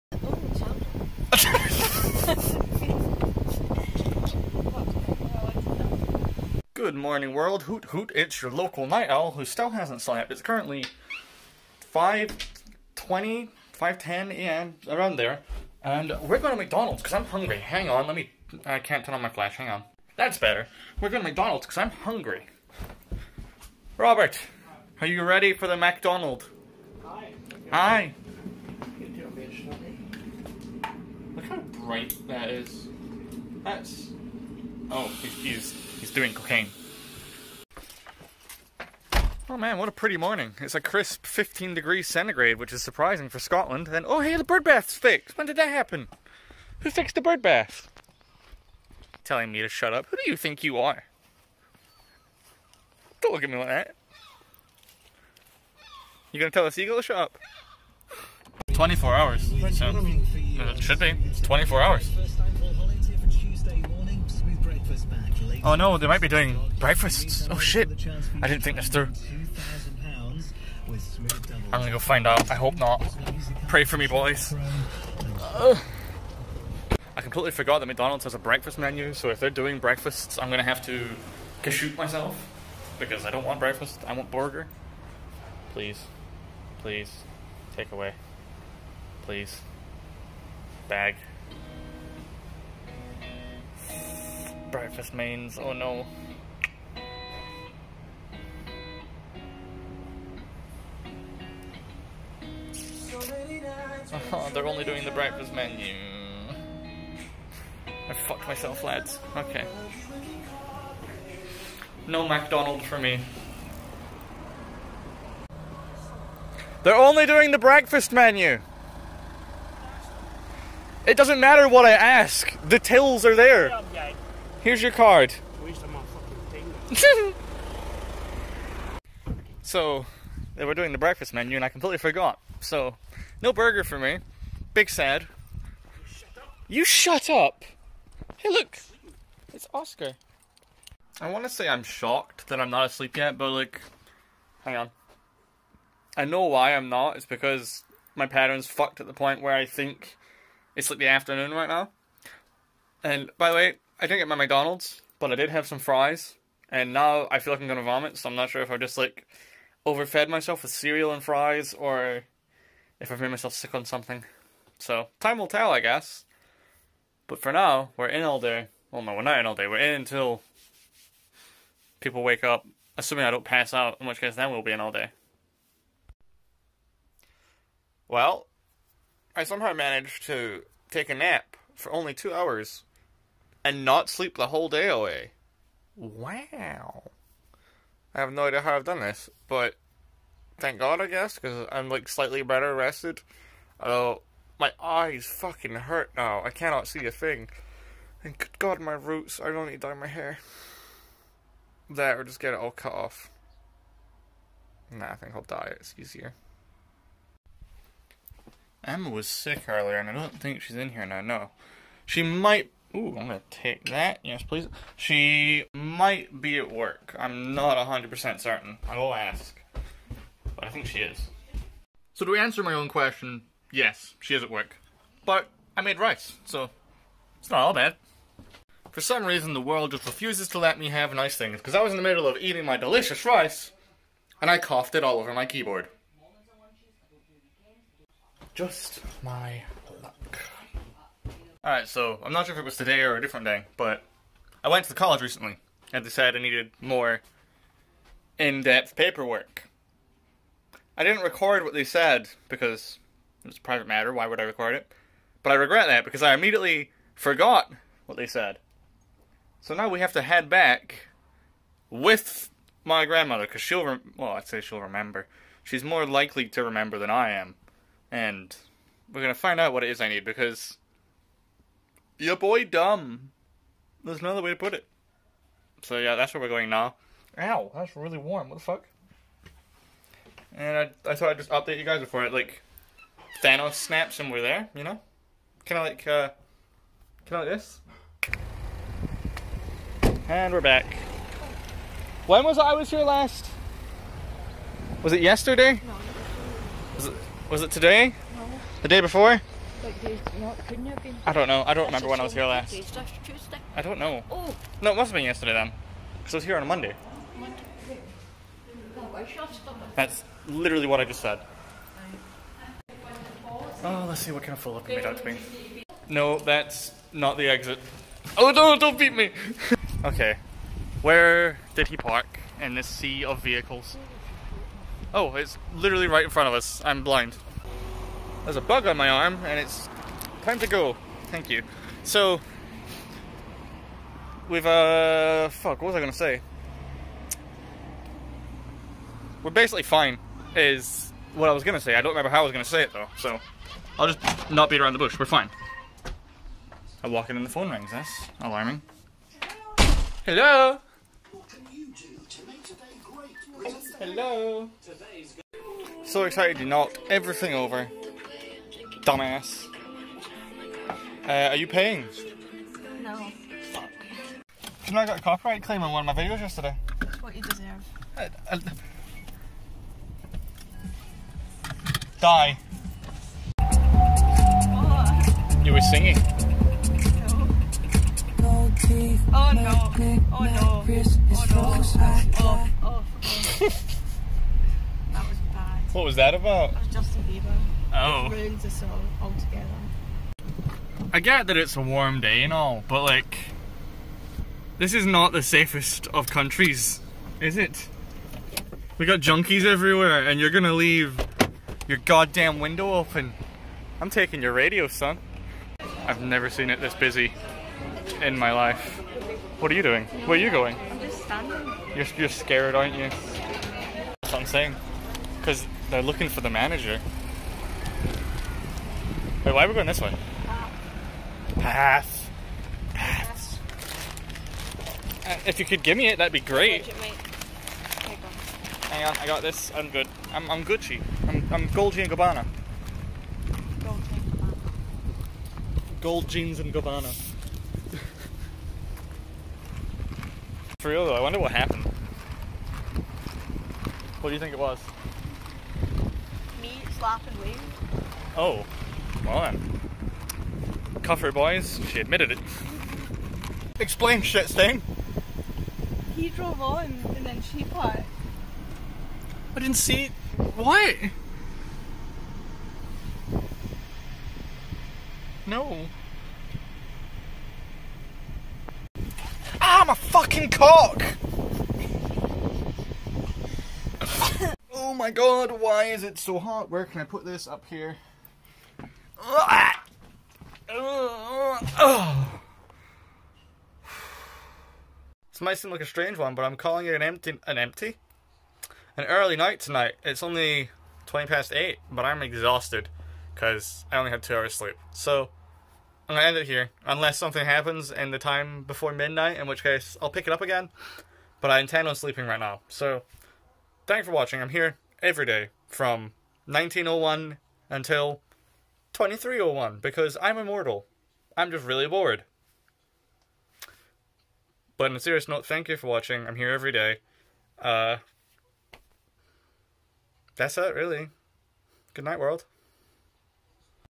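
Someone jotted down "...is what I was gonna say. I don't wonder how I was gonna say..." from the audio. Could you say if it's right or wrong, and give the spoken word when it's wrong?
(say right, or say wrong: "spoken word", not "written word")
wrong: "remember", not "wonder".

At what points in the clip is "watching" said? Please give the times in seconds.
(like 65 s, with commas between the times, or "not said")
504 s, 515 s.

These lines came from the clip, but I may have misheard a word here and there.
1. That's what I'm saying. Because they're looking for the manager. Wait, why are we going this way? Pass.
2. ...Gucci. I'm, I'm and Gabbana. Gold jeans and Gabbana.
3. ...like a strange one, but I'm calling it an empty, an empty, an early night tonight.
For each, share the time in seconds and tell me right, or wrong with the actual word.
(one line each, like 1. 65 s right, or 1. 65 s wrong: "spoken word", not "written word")
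1. 414 s right
2. 430 s right
3. 485 s right.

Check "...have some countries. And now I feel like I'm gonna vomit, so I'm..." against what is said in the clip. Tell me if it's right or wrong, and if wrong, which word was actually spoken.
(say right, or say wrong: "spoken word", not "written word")
wrong: "fries", not "countries".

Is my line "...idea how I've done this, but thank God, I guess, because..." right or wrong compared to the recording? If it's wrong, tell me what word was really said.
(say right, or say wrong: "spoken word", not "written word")
right.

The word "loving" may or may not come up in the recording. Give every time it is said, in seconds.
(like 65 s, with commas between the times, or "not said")
not said.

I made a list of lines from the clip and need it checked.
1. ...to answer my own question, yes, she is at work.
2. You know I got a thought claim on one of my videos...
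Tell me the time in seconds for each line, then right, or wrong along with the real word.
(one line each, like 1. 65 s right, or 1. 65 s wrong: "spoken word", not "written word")
1. 222 s right
2. 364 s wrong: "copyright", not "thought".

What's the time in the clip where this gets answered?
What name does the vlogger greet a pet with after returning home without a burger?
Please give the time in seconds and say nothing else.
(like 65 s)
139 s.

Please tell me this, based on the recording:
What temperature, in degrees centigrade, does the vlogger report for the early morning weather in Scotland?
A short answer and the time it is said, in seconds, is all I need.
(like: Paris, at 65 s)
15, at 41 s.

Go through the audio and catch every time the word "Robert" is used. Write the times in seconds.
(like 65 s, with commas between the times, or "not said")
23 s.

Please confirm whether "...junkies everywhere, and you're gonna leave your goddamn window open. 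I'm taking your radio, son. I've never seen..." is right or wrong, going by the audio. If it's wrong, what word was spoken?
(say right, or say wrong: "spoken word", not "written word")
right.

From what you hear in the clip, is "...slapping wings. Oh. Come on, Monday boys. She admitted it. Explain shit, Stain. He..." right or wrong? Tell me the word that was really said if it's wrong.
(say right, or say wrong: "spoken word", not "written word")
wrong: "Cuff", not "Monday".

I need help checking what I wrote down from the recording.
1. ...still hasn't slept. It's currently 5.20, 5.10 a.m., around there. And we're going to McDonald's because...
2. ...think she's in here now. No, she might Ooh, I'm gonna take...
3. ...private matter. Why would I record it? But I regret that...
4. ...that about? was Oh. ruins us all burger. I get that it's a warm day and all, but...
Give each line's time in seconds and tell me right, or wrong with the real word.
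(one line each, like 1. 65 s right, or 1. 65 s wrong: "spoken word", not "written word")
1. 9 s right
2. 210 s right
3. 253 s right
4. 386 s wrong: "altogether", not "burger".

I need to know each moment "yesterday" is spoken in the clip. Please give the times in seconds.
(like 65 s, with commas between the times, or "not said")
295 s, 305 s, 366 s.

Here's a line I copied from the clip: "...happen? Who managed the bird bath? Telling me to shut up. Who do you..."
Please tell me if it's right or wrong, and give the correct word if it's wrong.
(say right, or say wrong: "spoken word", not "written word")
wrong: "fixed", not "managed".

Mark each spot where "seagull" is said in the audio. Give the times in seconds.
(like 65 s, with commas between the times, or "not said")
56 s.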